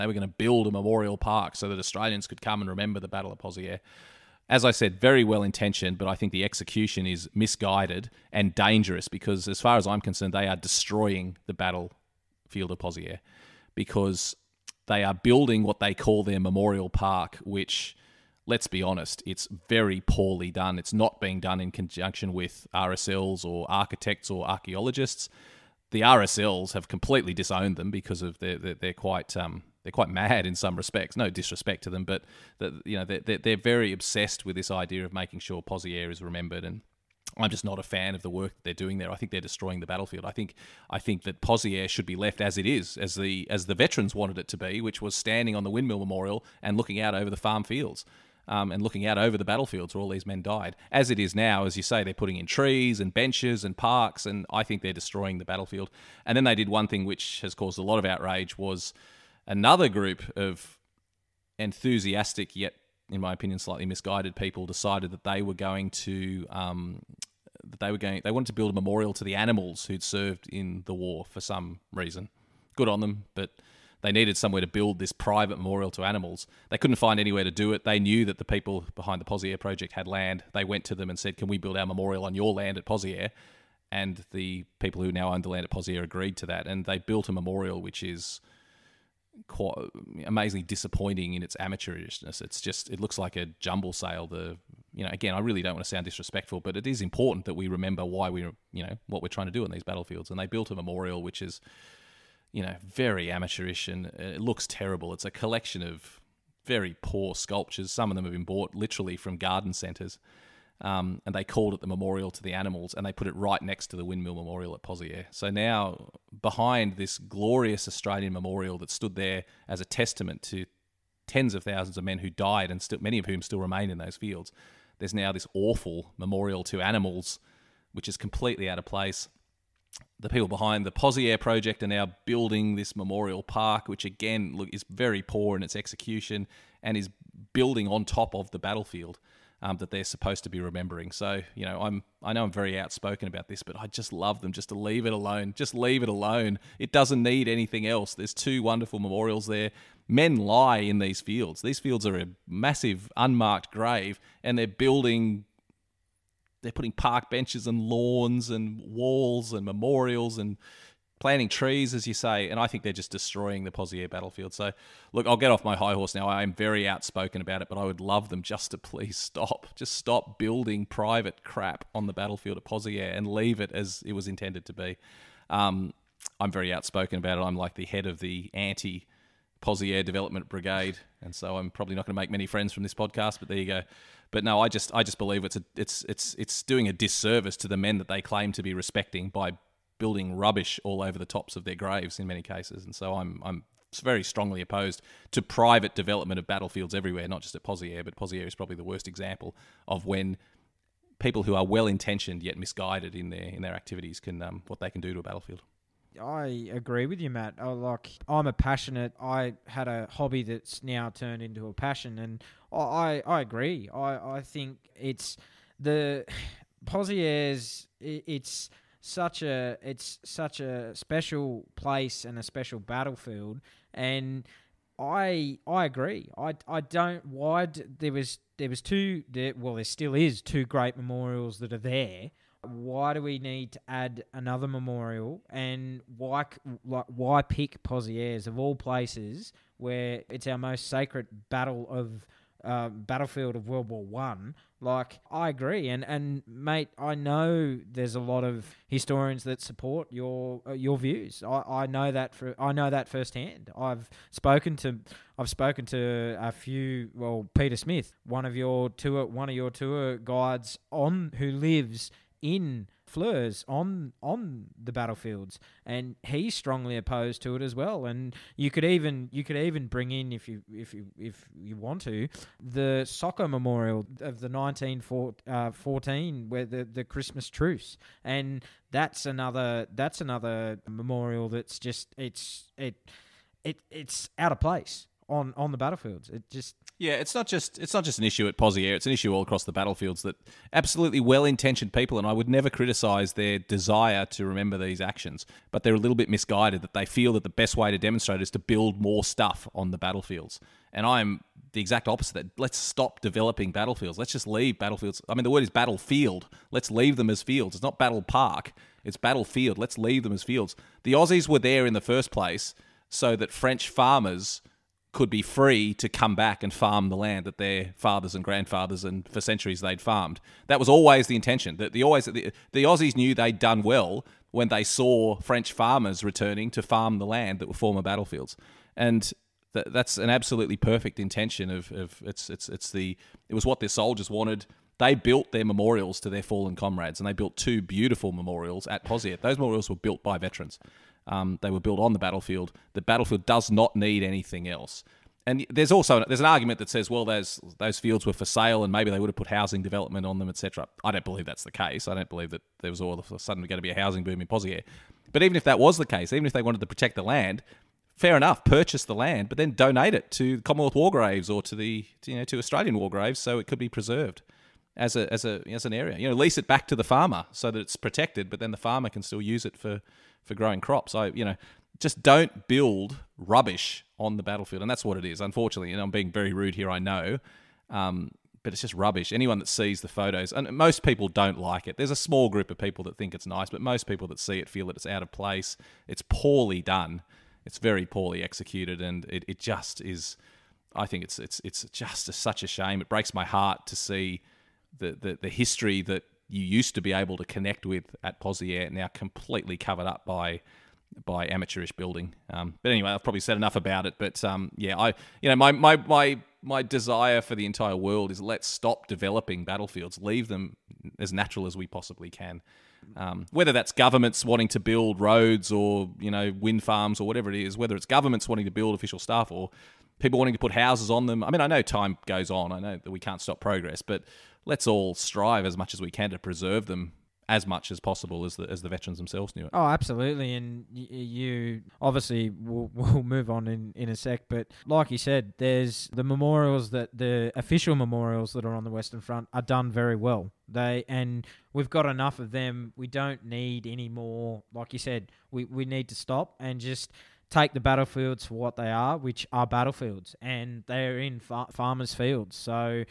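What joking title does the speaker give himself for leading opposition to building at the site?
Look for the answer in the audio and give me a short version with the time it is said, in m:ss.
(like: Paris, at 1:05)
Head of the anti Pozieres Development Brigade, at 2:58.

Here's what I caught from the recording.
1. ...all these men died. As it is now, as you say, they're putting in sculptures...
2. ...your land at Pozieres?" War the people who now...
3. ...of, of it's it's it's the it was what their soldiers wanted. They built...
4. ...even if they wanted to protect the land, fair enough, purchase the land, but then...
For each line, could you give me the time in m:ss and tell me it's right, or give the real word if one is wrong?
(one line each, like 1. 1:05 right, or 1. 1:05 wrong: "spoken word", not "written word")
1. 0:49 wrong: "trees", not "sculptures"
2. 1:22 wrong: "And", not "War"
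3. 5:31 right
4. 5:56 right.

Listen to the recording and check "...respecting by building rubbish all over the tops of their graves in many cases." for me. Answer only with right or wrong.
right.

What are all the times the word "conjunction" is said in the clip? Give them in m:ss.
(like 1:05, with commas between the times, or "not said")
0:21.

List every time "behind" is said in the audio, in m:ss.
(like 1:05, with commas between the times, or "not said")
1:18, 1:56, 2:10.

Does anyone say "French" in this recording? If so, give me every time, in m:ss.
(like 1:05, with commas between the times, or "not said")
5:13, 5:25.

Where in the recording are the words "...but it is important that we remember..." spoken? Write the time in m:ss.
1:36.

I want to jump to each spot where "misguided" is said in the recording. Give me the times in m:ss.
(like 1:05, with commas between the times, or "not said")
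0:07, 1:03, 3:22, 4:56.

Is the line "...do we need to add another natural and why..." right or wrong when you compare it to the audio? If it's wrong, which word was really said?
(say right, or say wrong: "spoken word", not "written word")
wrong: "memorial", not "natural".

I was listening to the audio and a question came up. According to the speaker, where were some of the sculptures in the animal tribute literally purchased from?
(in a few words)
Garden centres.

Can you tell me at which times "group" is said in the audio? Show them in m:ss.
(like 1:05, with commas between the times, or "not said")
0:59, 6:22.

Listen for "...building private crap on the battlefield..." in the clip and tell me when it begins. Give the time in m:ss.
2:50.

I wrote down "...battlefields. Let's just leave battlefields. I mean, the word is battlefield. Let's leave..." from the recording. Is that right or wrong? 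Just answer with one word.
right.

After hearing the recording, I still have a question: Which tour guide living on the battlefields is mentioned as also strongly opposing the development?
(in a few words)
Peter Smith.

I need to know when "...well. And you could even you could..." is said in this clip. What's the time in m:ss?
4:27.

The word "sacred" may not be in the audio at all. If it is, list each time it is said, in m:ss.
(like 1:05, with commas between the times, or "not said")
4:00.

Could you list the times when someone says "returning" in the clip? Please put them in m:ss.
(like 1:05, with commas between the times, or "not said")
5:26.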